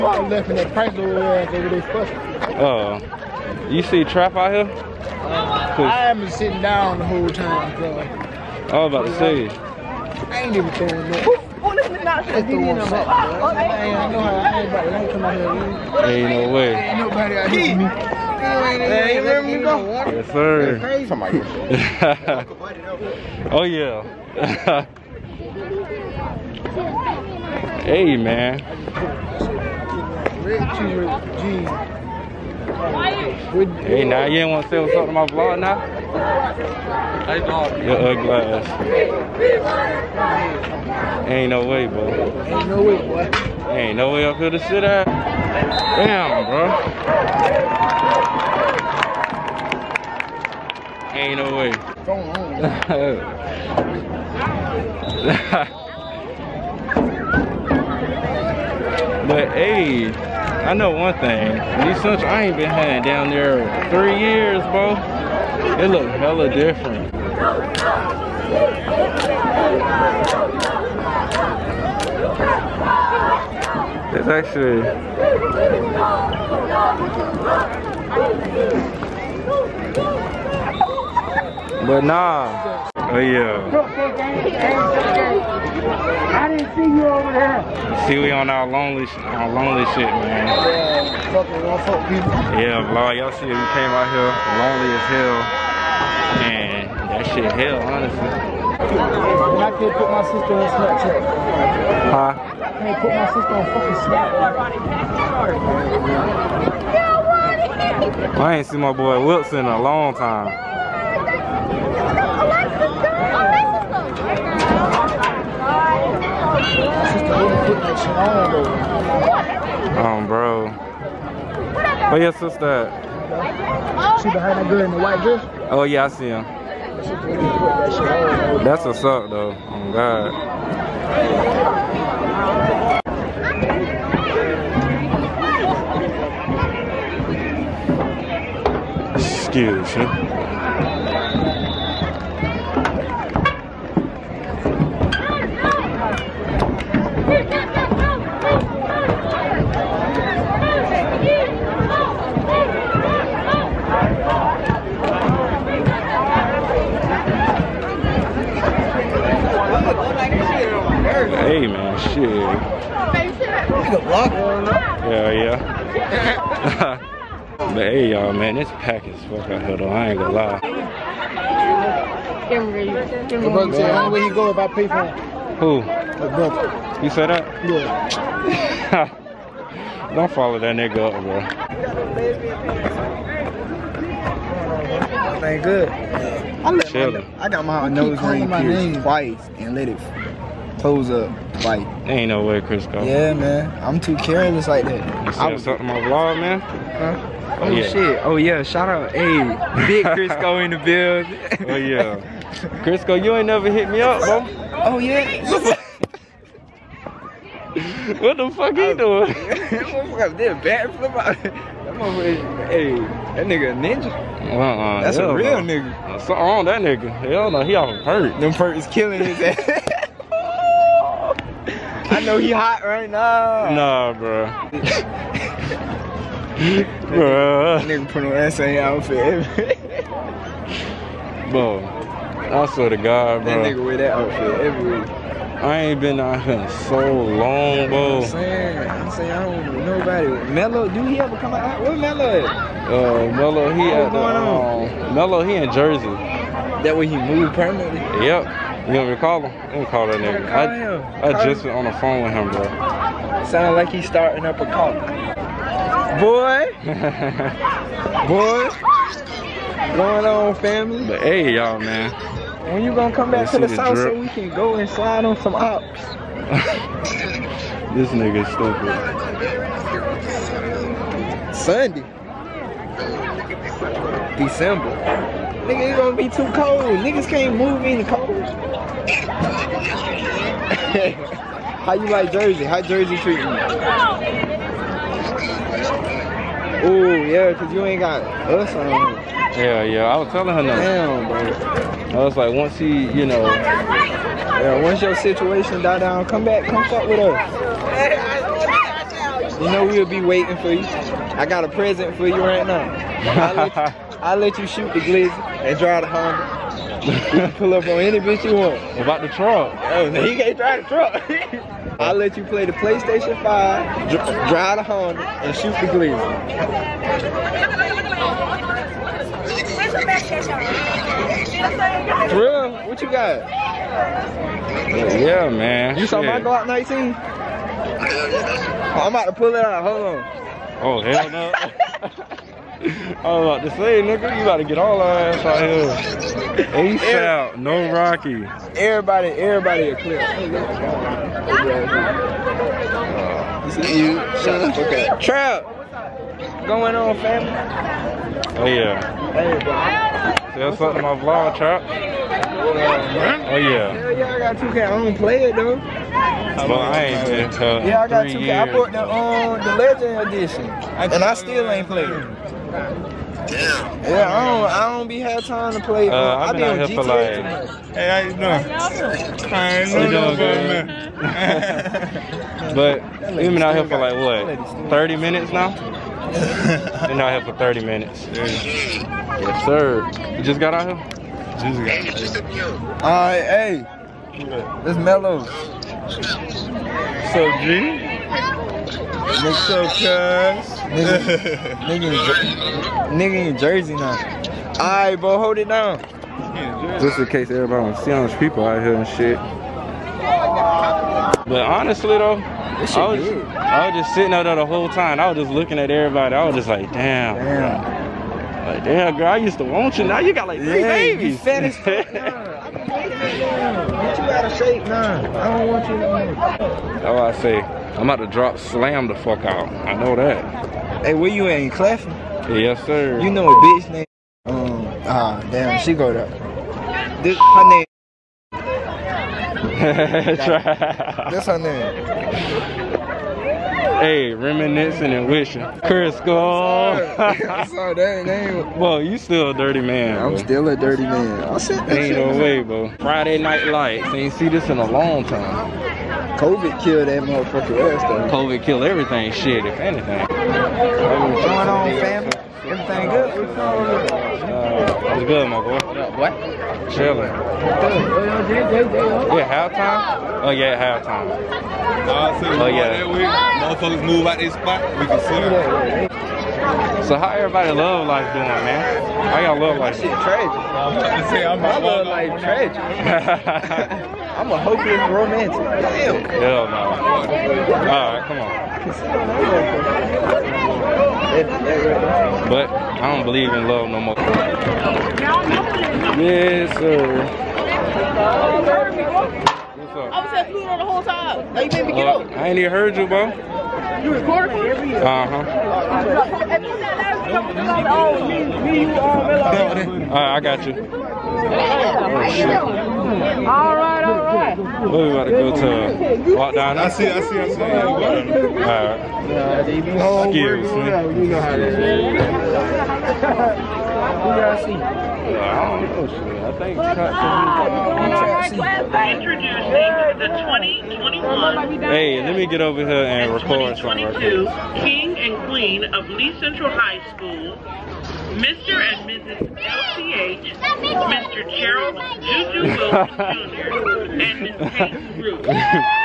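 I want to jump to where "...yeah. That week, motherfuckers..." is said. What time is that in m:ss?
7:42.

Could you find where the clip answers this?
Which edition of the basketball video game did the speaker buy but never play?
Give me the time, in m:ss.
5:59.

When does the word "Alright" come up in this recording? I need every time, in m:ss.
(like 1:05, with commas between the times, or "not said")
6:34, 7:57.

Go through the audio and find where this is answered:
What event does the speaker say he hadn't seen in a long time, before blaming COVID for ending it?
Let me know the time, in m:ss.
7:22.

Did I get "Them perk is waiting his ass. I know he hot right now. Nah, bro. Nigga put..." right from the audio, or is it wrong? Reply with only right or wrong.
wrong.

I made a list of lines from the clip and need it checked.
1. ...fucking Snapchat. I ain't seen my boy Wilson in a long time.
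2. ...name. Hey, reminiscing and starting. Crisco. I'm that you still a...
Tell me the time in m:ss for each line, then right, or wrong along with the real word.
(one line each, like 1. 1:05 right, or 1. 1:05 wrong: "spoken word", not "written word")
1. 1:43 right
2. 7:11 wrong: "wishing", not "starting".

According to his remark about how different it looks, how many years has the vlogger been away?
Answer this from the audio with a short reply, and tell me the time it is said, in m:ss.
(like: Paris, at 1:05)
3, at 1:03.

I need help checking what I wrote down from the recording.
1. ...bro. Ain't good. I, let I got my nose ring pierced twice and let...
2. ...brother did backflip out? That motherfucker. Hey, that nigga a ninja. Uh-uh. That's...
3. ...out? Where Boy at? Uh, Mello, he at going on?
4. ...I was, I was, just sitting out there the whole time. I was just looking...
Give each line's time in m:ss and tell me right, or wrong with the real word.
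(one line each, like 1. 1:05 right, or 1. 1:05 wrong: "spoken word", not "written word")
1. 3:05 right
2. 3:29 wrong: "motherfucker", not "brother"
3. 4:01 wrong: "Mello", not "Boy"
4. 6:42 right.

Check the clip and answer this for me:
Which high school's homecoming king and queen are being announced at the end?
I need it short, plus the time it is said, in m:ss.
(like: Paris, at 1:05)
Lee Central High School, at 8:46.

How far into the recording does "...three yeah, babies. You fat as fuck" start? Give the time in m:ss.
6:50.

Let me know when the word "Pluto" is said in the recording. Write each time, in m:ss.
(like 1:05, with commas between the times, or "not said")
8:10.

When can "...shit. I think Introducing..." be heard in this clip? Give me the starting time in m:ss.
8:36.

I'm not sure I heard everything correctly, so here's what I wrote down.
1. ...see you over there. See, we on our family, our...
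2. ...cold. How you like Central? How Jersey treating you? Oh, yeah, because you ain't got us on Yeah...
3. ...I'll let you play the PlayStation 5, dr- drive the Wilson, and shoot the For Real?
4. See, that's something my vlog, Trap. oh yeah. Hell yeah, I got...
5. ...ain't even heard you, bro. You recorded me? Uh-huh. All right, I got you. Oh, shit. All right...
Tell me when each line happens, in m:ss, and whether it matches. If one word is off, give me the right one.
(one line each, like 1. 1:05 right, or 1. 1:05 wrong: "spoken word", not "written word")
1. 1:26 wrong: "lonely", not "family"
2. 4:38 wrong: "Jersey", not "Central"
3. 5:11 wrong: "Honda", not "Wilson"
4. 5:50 right
5. 8:12 right.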